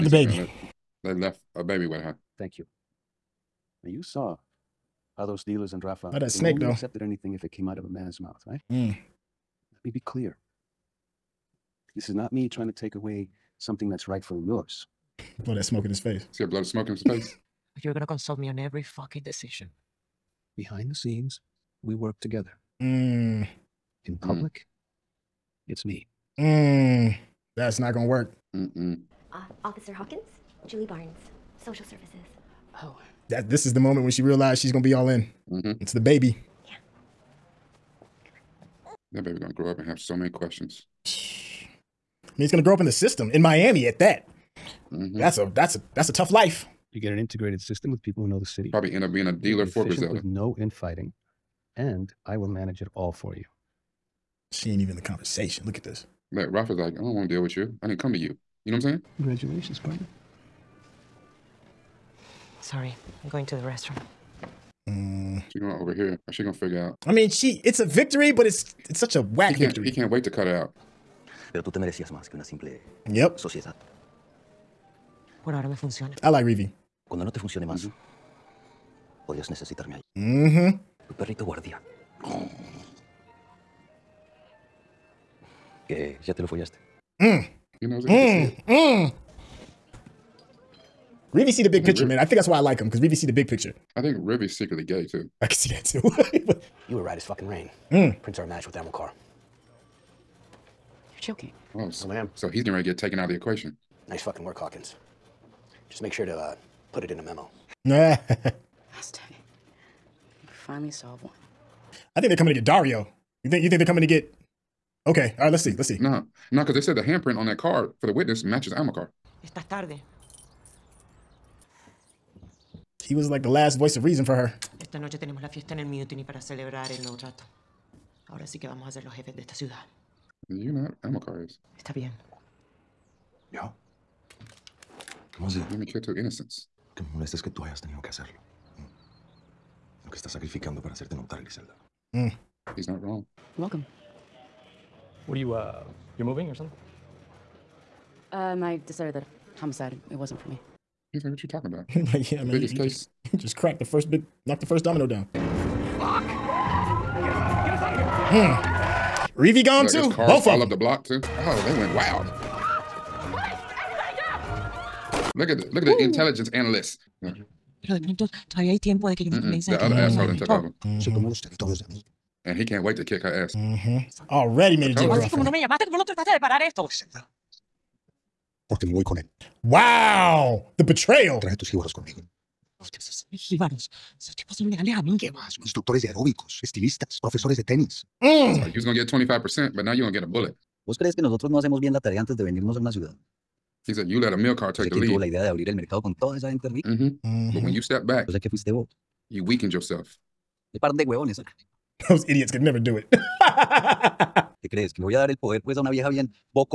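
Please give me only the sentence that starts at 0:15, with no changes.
Blow that smoke in his face.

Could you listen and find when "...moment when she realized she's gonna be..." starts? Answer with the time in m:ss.
0:33.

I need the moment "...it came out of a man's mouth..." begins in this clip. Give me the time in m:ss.
0:07.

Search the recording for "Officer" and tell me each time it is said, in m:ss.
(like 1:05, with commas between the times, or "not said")
0:29.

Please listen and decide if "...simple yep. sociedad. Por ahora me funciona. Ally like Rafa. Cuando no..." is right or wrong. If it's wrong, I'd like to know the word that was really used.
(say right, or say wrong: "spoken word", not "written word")
wrong: "Reeve", not "Rafa".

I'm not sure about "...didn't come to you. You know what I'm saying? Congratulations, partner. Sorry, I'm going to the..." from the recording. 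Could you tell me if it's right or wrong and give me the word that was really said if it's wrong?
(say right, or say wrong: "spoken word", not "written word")
right.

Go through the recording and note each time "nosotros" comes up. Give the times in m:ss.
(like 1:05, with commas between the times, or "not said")
3:11.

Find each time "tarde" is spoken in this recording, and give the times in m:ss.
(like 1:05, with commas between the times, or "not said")
1:59.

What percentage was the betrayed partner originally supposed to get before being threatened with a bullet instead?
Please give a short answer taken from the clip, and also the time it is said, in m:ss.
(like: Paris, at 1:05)
25%, at 3:09.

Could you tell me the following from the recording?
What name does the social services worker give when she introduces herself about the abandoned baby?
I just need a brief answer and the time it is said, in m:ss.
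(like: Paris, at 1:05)
Julie Barnes, at 0:30.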